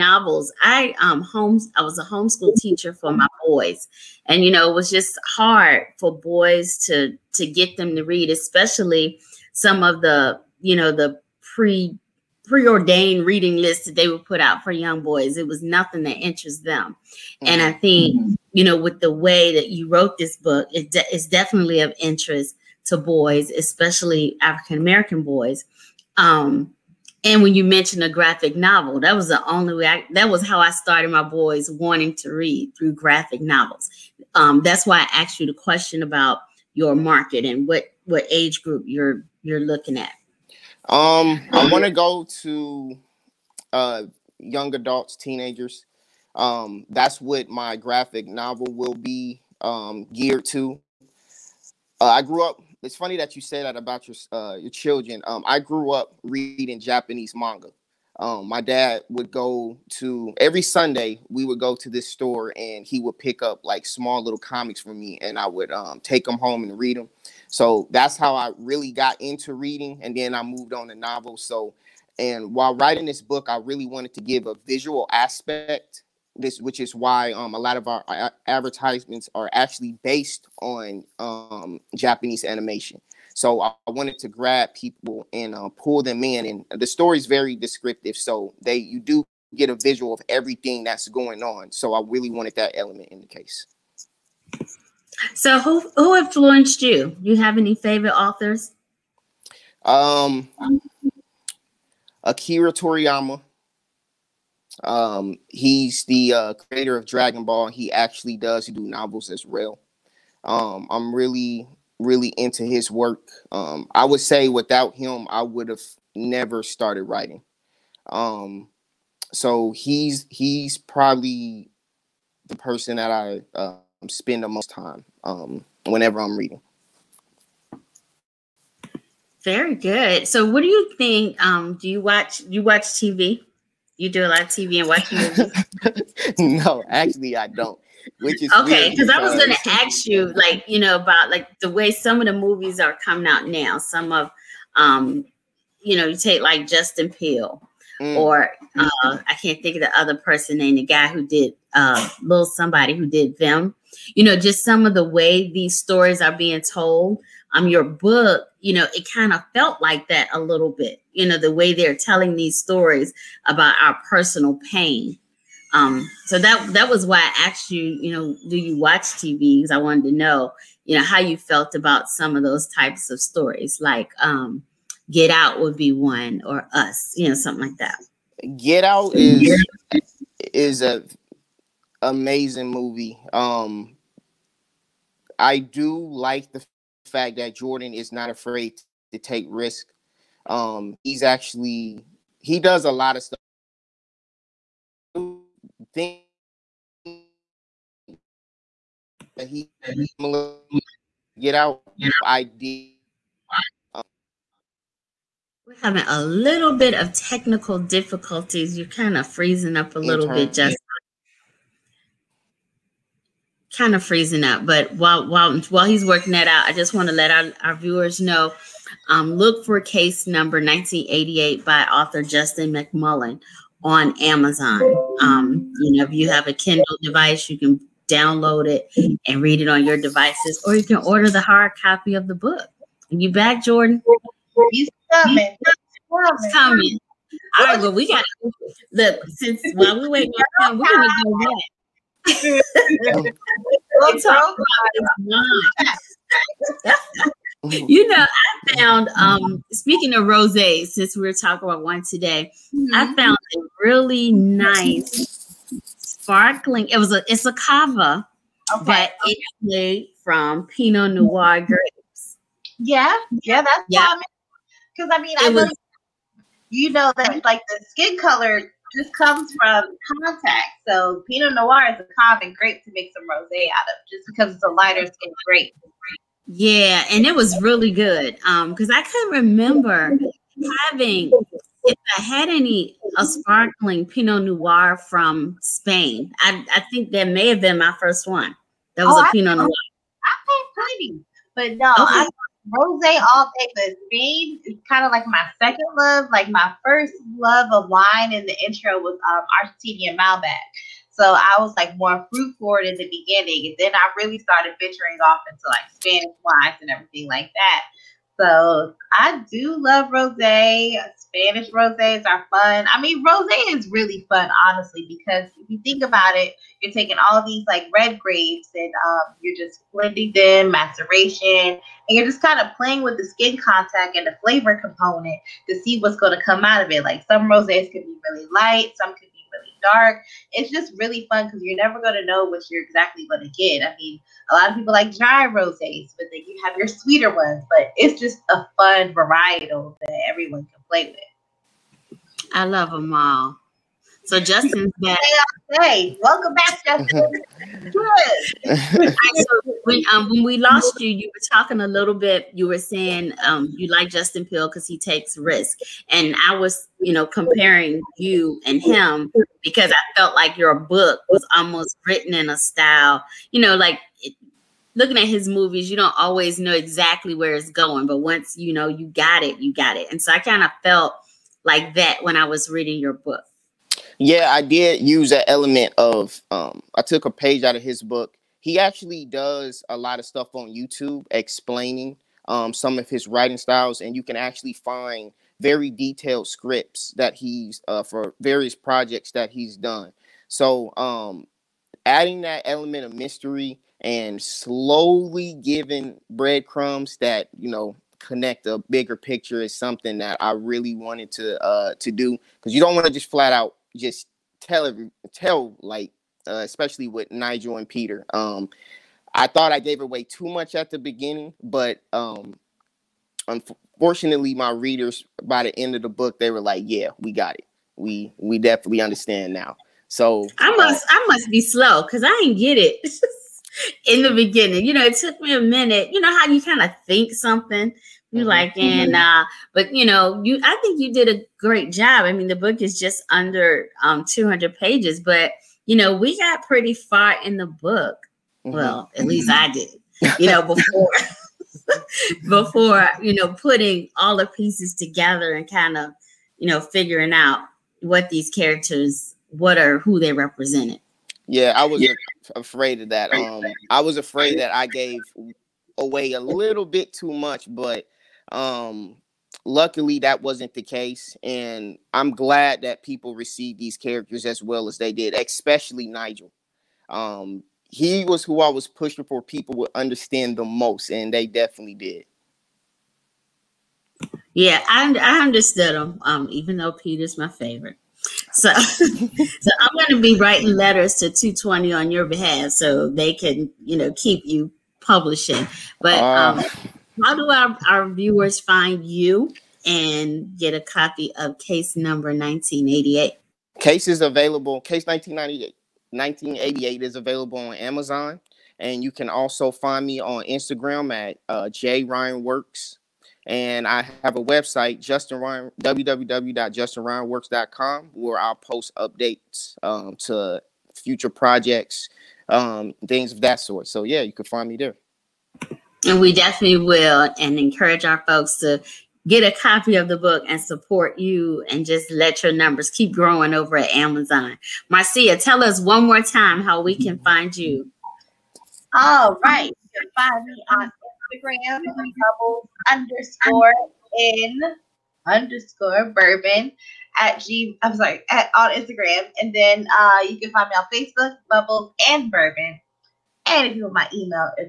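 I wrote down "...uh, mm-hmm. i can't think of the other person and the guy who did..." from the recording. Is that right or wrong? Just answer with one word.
right.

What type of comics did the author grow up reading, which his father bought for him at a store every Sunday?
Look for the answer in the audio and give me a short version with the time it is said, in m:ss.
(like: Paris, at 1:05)
Japanese manga, at 0:56.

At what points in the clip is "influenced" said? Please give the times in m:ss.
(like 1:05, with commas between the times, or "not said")
1:36.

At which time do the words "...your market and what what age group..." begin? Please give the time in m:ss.
0:36.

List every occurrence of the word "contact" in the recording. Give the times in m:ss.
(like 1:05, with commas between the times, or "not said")
4:30, 5:23.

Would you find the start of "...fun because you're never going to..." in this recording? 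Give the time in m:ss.
5:31.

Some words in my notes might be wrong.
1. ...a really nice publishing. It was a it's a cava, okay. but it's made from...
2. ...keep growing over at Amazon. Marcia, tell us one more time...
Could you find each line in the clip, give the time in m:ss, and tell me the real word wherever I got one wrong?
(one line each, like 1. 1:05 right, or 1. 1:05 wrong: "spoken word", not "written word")
1. 4:13 wrong: "sparkling", not "publishing"
2. 8:42 right.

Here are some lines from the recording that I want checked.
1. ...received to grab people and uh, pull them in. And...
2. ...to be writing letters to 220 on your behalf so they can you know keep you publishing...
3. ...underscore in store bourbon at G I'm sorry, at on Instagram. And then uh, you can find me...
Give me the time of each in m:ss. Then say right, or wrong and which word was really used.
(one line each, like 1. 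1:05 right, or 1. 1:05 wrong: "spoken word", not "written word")
1. 1:23 wrong: "wanted", not "received"
2. 8:00 right
3. 8:52 wrong: "underscore", not "store".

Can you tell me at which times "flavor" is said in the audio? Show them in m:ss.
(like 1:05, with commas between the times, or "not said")
5:24.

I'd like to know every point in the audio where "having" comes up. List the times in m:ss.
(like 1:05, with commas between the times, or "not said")
3:25, 4:40.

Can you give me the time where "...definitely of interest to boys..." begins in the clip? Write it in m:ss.
0:21.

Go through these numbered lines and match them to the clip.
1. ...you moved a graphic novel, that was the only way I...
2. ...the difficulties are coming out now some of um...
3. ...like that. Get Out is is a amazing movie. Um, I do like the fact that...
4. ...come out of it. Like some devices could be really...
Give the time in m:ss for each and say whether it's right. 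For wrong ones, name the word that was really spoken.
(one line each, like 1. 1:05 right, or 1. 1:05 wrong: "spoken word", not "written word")
1. 0:27 wrong: "mentioned", not "moved"
2. 2:22 wrong: "movies", not "difficulties"
3. 2:57 right
4. 5:26 wrong: "roses", not "devices".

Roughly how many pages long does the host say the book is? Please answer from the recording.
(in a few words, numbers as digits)
200.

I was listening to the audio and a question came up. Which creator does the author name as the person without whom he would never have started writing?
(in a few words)
Akira Toriyama.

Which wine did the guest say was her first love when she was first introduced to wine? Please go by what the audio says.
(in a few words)
Argentinian Malbec.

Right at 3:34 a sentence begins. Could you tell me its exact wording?
But while while while he's working that out, I just want to let our, our viewers know.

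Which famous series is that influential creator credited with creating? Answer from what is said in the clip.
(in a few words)
Dragon Ball.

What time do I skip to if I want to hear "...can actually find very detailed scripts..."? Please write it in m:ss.
6:24.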